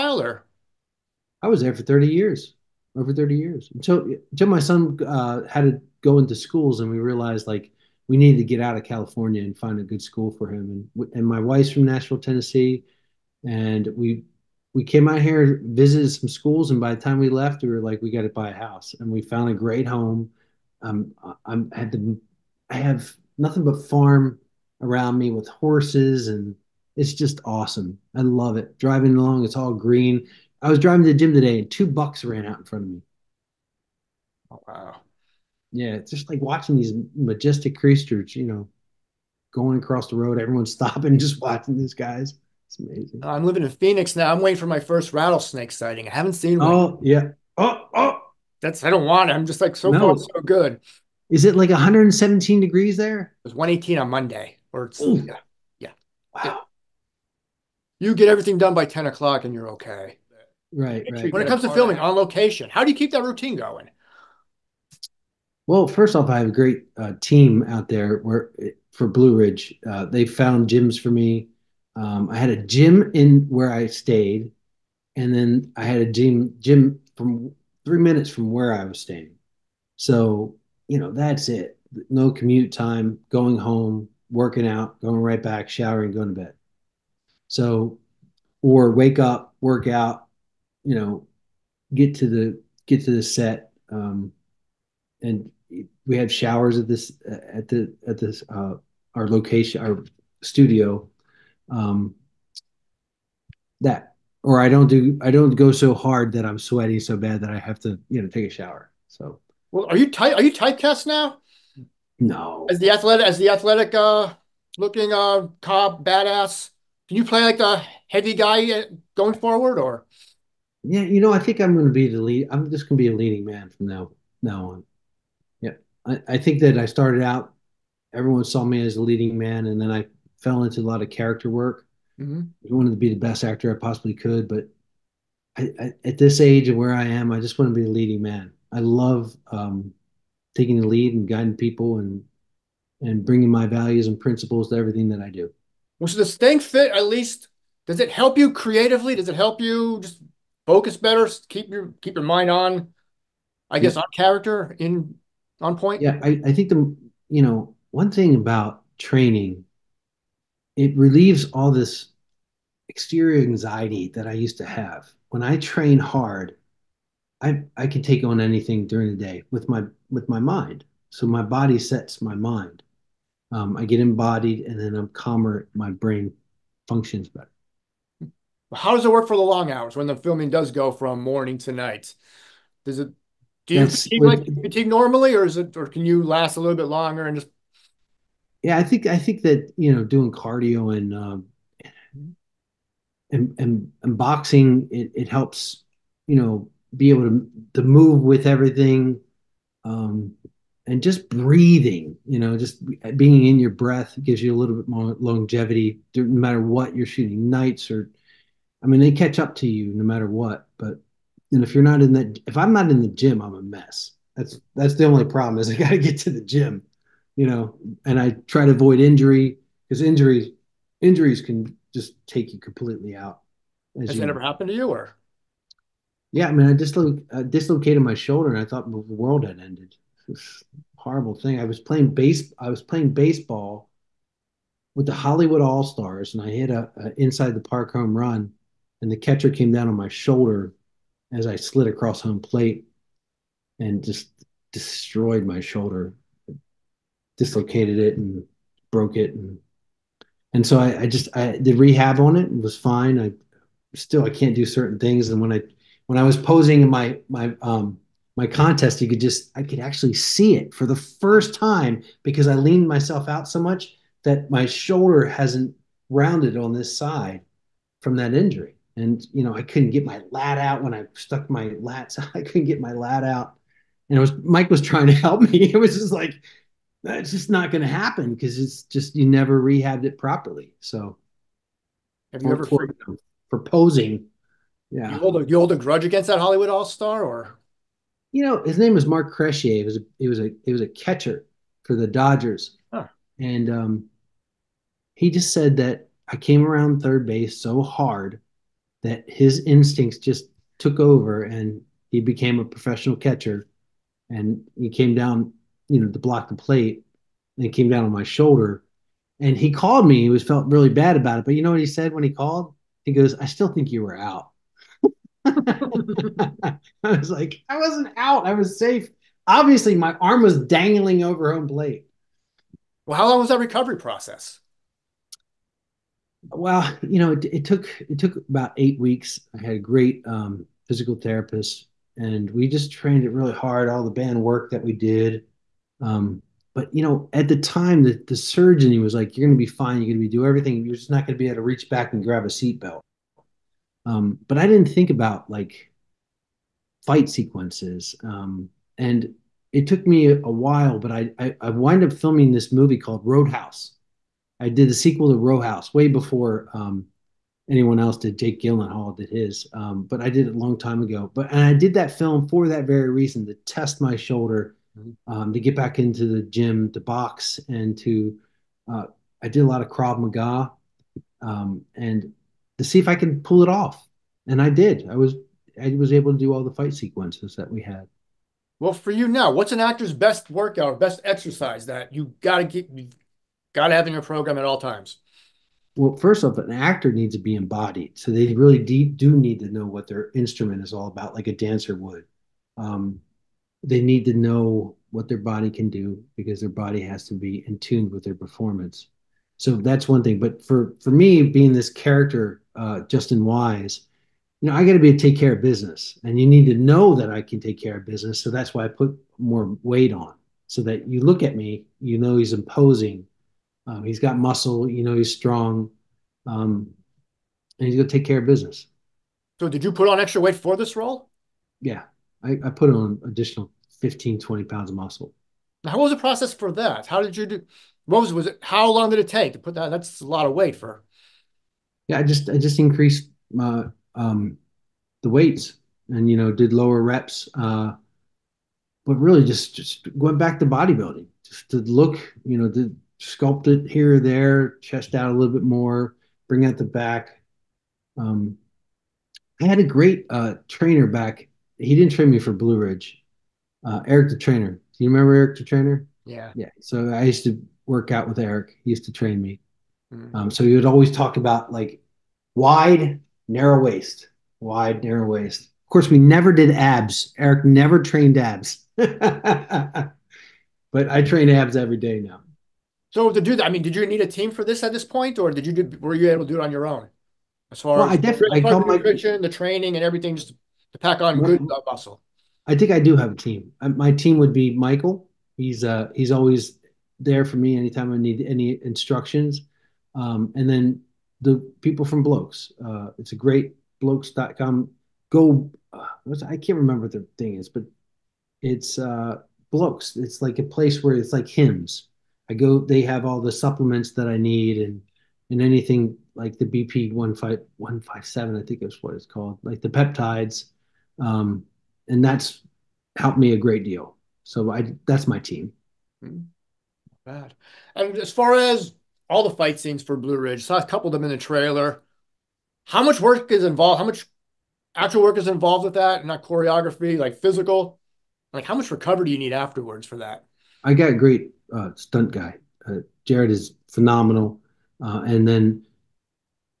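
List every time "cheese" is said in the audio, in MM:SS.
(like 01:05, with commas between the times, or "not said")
not said.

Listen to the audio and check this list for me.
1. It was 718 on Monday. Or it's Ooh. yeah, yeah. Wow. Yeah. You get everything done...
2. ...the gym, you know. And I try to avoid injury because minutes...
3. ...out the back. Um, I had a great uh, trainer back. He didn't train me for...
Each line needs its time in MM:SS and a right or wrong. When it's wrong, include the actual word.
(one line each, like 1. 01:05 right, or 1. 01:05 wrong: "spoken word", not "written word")
1. 00:53 wrong: "118", not "718"
2. 03:36 wrong: "injuries", not "minutes"
3. 07:26 right.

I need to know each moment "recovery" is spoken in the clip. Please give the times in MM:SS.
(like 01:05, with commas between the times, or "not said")
05:23, 08:48.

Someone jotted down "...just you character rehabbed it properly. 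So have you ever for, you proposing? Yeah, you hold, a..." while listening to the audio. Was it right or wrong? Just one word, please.
wrong.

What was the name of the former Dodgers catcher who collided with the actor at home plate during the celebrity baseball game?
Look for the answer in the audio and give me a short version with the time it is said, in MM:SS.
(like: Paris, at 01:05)
Mark Cresse, at 04:49.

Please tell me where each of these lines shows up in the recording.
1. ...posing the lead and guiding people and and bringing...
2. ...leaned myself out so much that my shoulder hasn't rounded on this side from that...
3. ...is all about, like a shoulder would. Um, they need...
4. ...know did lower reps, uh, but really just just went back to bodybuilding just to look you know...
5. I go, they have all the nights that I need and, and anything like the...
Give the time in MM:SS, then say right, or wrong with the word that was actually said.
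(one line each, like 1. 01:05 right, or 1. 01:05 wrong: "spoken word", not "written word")
1. 02:20 wrong: "taking", not "posing"
2. 04:22 right
3. 06:30 wrong: "dancer", not "shoulder"
4. 07:16 right
5. 08:22 wrong: "supplements", not "nights".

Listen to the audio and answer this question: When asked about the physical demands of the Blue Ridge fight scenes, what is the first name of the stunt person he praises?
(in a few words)
Jared.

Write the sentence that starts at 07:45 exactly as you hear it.
Of course, we never did abs.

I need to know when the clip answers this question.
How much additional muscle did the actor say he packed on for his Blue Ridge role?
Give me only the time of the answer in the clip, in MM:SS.
07:03.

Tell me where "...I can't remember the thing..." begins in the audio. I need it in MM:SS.
08:16.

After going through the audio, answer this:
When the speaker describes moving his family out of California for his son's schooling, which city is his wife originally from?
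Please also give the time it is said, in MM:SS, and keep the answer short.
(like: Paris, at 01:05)
Nashville, at 00:11.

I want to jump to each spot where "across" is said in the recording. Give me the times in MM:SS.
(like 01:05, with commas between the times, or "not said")
00:39, 04:01.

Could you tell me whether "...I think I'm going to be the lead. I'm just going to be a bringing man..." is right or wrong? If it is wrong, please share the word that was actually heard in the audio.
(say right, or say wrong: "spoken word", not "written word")
wrong: "leading", not "bringing".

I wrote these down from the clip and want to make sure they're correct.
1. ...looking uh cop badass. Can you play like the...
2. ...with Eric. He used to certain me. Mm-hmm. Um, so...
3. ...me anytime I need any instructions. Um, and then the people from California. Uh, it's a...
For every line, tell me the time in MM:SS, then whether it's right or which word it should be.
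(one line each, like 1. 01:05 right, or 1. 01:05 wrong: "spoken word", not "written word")
1. 01:54 right
2. 07:38 wrong: "train", not "certain"
3. 08:07 wrong: "Blokes", not "California".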